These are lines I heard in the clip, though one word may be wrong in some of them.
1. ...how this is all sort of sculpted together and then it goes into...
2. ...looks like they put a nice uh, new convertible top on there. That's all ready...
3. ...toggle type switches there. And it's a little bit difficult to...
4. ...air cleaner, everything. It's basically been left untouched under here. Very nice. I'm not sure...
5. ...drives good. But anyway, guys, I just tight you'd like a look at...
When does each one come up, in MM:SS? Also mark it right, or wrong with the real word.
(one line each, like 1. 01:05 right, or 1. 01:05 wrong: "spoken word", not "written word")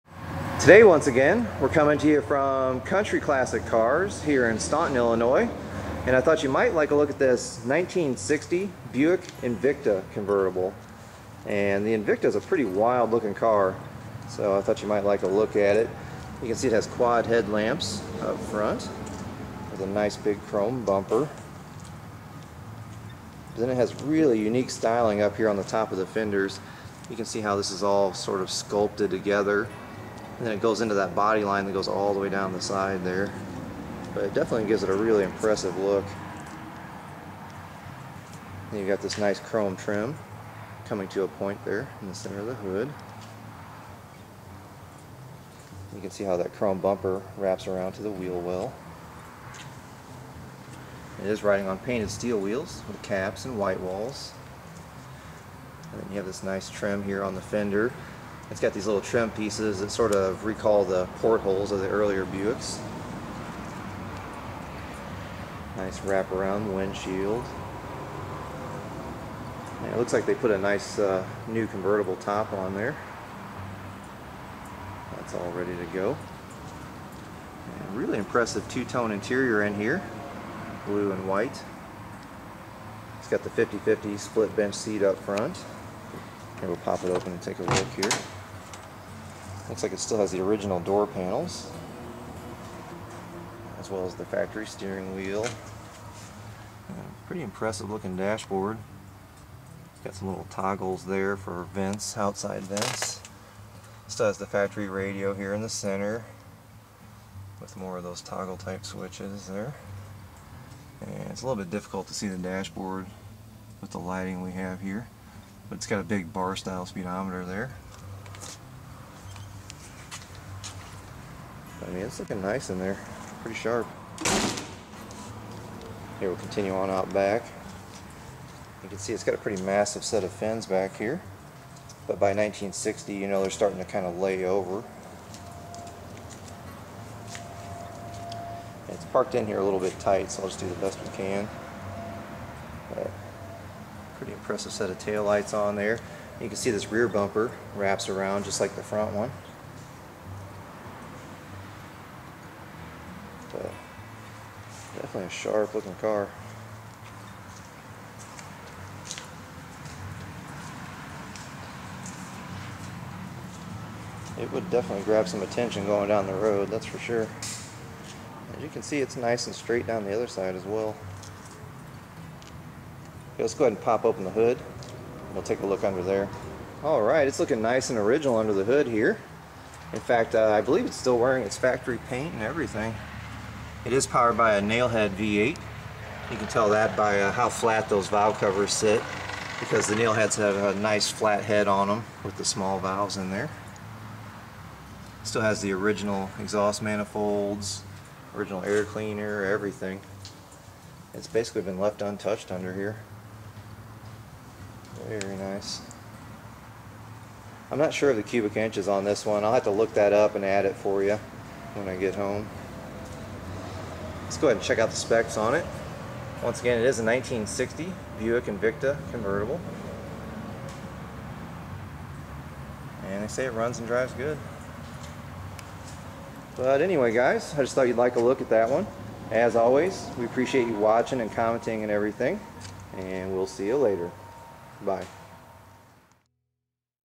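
1. 00:27 right
2. 01:09 right
3. 01:48 right
4. 03:18 right
5. 03:43 wrong: "thought", not "tight".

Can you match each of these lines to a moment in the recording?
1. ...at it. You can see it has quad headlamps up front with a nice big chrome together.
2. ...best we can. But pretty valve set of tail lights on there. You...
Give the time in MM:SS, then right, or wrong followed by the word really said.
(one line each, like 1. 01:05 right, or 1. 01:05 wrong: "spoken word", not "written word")
1. 00:15 wrong: "bumper", not "together"
2. 02:20 wrong: "impressive", not "valve".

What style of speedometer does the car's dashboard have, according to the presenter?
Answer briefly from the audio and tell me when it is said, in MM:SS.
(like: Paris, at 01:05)
Bar style, at 01:56.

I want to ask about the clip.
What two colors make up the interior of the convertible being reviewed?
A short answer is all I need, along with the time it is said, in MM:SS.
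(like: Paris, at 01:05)
Blue and white, at 01:20.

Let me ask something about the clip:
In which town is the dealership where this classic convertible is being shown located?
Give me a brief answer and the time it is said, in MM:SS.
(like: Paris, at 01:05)
Staunton, Illinois, at 00:04.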